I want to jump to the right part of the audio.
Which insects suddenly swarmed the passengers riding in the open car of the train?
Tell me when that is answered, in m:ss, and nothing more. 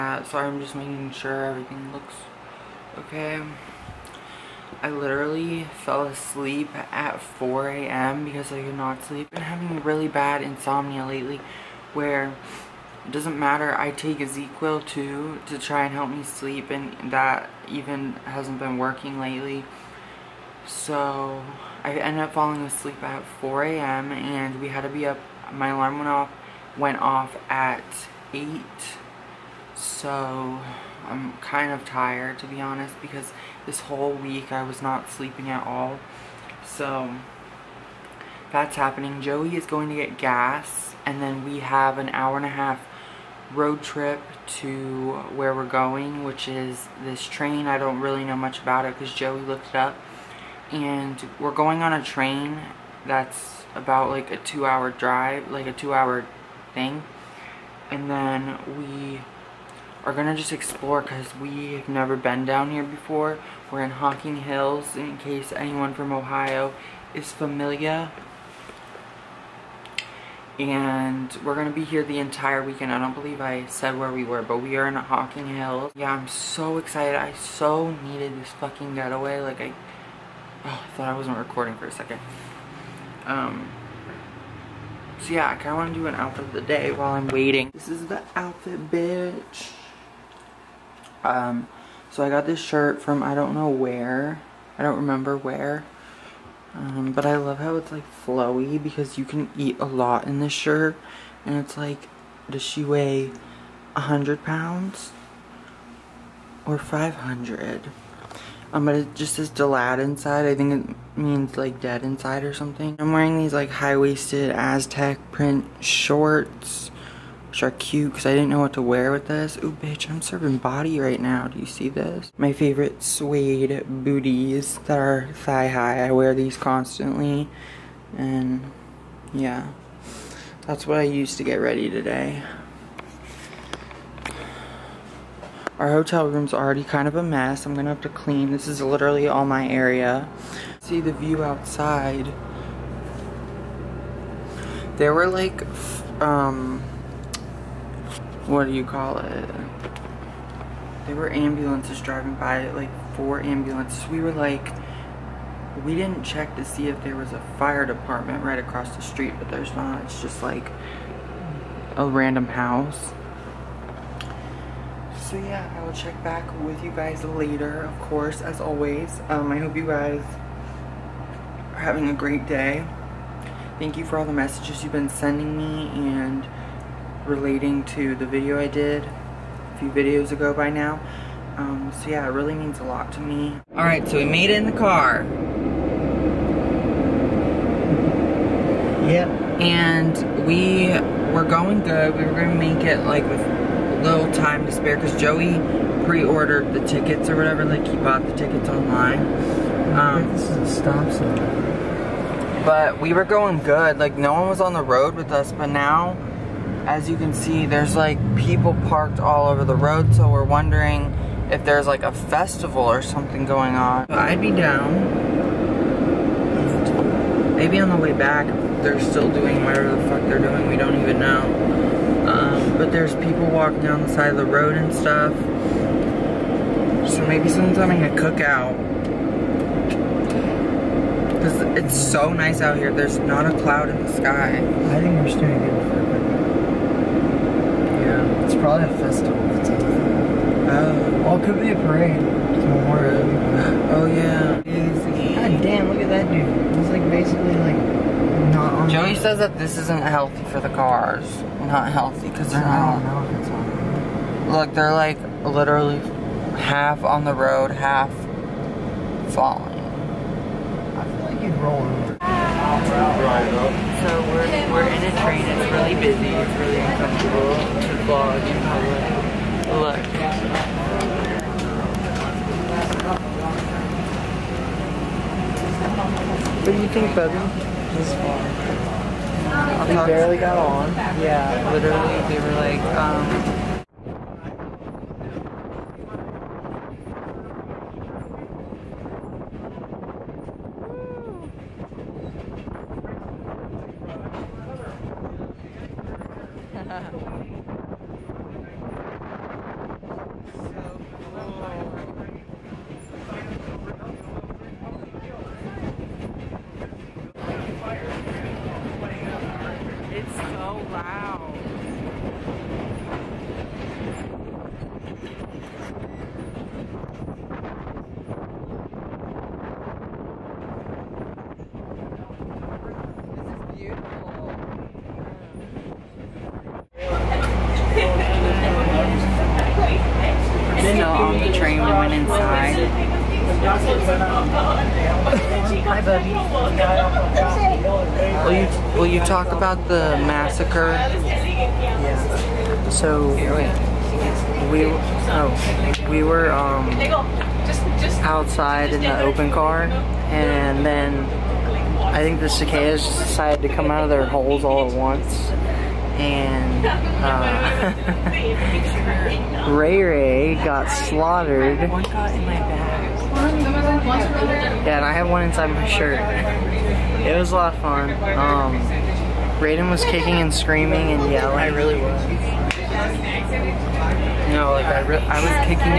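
5:52.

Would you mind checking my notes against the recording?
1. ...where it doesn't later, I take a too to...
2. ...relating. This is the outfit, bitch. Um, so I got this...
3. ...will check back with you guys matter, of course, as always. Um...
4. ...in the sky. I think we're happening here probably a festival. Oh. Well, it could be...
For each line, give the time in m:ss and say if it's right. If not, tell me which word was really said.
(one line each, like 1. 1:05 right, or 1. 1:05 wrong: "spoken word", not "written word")
1. 0:11 wrong: "matter", not "later"
2. 1:27 wrong: "waiting", not "relating"
3. 2:45 wrong: "later", not "matter"
4. 3:53 wrong: "staying", not "happening".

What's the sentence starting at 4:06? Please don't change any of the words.
He's like basically like not on Joey says that this isn't healthy for the cars.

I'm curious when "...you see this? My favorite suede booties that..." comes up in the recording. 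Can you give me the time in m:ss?
2:01.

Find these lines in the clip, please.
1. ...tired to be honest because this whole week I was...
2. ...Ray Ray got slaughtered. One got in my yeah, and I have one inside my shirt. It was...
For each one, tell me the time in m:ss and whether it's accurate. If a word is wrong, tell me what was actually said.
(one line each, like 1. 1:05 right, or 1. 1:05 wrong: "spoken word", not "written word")
1. 0:31 right
2. 5:59 right.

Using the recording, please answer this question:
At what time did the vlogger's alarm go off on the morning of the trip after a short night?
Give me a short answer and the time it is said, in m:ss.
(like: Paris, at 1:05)
8, at 0:26.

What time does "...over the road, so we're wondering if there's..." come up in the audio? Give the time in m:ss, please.
3:29.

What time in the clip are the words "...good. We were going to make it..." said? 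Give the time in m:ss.
3:11.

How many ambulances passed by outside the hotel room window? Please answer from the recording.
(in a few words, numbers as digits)
4.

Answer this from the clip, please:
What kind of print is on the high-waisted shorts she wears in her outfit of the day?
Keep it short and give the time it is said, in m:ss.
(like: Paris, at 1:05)
Aztec, at 1:54.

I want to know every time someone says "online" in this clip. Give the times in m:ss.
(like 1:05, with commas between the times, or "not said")
3:18.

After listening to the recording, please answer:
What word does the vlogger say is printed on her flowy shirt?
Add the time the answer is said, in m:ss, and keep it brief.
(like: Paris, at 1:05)
Delad, at 1:49.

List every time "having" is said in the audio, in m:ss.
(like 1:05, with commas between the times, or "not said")
0:09, 2:51, 3:47.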